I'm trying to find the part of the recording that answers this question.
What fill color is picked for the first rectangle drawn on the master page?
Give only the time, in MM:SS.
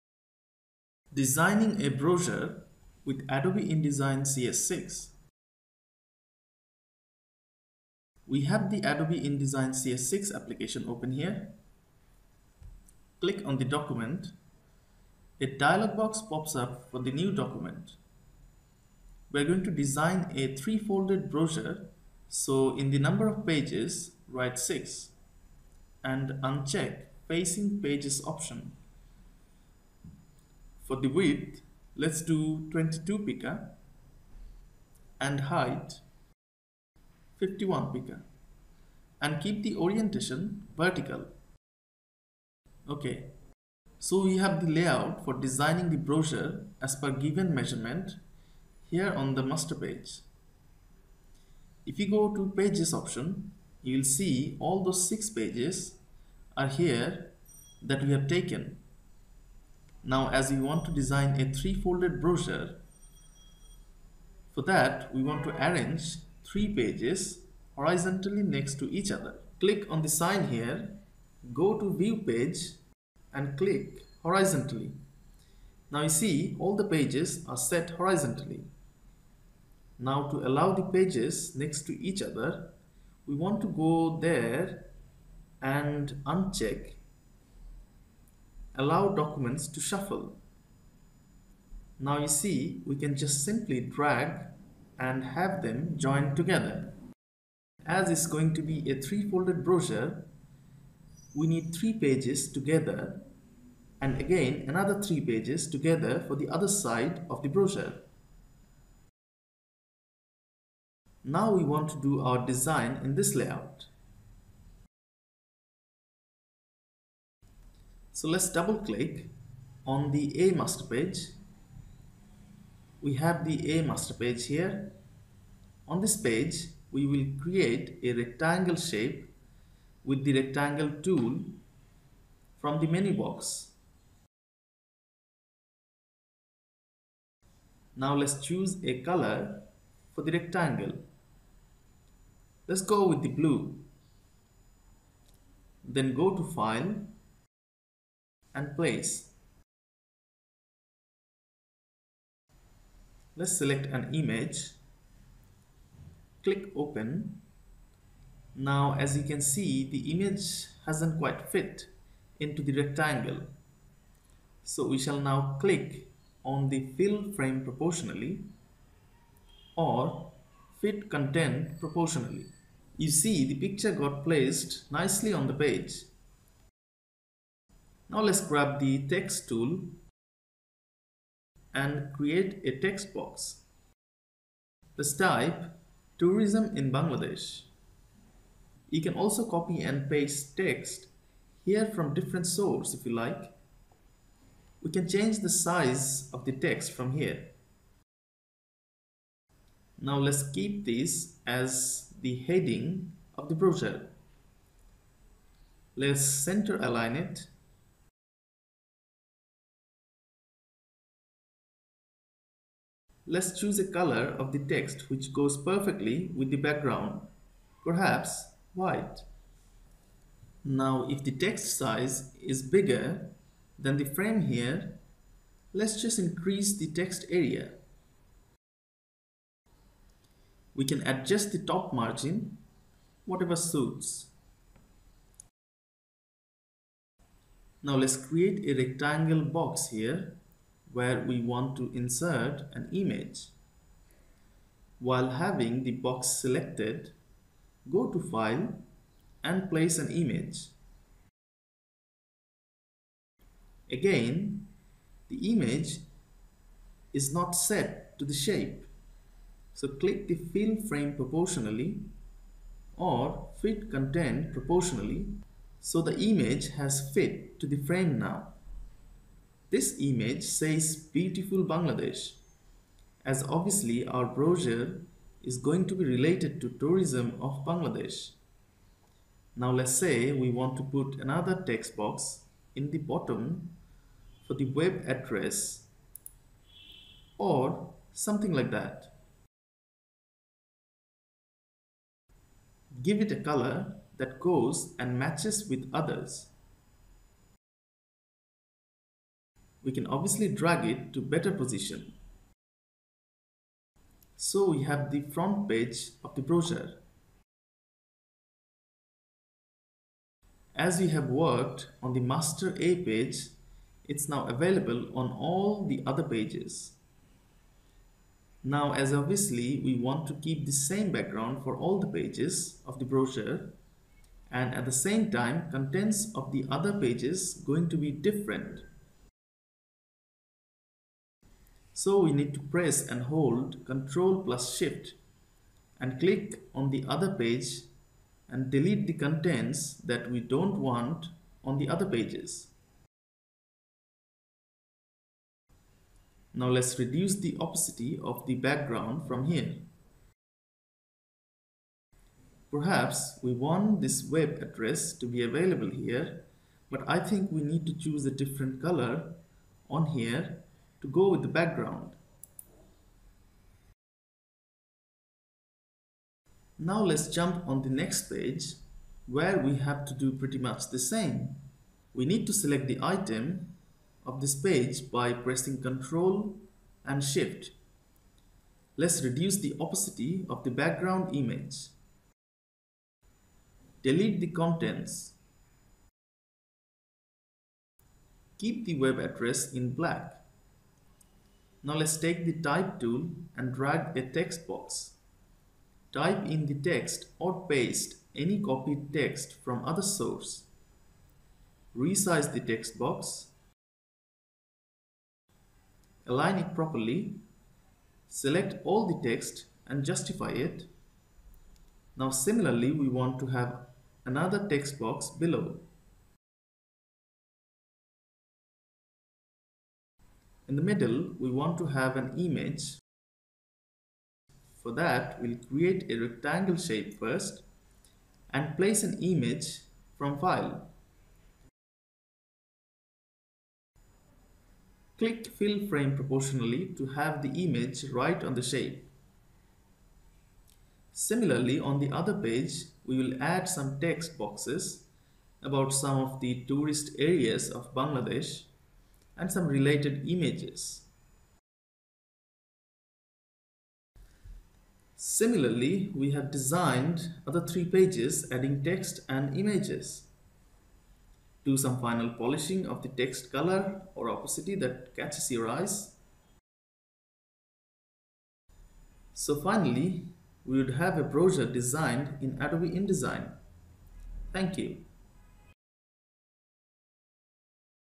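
02:23.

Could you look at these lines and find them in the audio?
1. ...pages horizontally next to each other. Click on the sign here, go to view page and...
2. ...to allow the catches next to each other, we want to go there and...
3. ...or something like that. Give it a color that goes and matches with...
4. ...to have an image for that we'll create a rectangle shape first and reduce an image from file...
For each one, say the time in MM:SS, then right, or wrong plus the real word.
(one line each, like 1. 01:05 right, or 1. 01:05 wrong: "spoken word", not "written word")
1. 01:06 right
2. 01:20 wrong: "pages", not "catches"
3. 04:47 right
4. 07:01 wrong: "place", not "reduce".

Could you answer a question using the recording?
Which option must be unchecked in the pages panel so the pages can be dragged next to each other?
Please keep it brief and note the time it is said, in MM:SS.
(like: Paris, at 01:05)
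allow documents to shuffle, at 01:28.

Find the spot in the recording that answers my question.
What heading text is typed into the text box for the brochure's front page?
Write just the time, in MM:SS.
03:06.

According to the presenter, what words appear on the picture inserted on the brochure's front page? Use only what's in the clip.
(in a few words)
beautiful Bangladesh.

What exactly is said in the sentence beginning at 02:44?
So we shall now click on the fill frame proportionally or fit content proportionally.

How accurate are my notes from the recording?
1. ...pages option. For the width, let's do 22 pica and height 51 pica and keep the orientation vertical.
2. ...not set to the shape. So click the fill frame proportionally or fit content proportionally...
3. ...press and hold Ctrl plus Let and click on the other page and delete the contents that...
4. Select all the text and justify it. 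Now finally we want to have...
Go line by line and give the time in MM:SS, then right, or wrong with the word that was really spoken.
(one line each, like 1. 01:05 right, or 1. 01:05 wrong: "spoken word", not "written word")
1. 00:27 right
2. 04:17 right
3. 05:32 wrong: "Shift", not "Let"
4. 06:48 wrong: "similarly", not "finally".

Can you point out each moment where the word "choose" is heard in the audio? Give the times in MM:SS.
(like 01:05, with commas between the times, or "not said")
02:18, 03:33, 05:57.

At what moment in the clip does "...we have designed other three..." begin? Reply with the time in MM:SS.
07:36.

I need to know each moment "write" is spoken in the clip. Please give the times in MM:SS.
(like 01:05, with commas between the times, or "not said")
00:24.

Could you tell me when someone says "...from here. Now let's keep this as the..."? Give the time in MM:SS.
03:16.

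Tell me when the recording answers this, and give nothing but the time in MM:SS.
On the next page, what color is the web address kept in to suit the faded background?
06:29.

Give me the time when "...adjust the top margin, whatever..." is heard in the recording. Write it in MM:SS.
03:51.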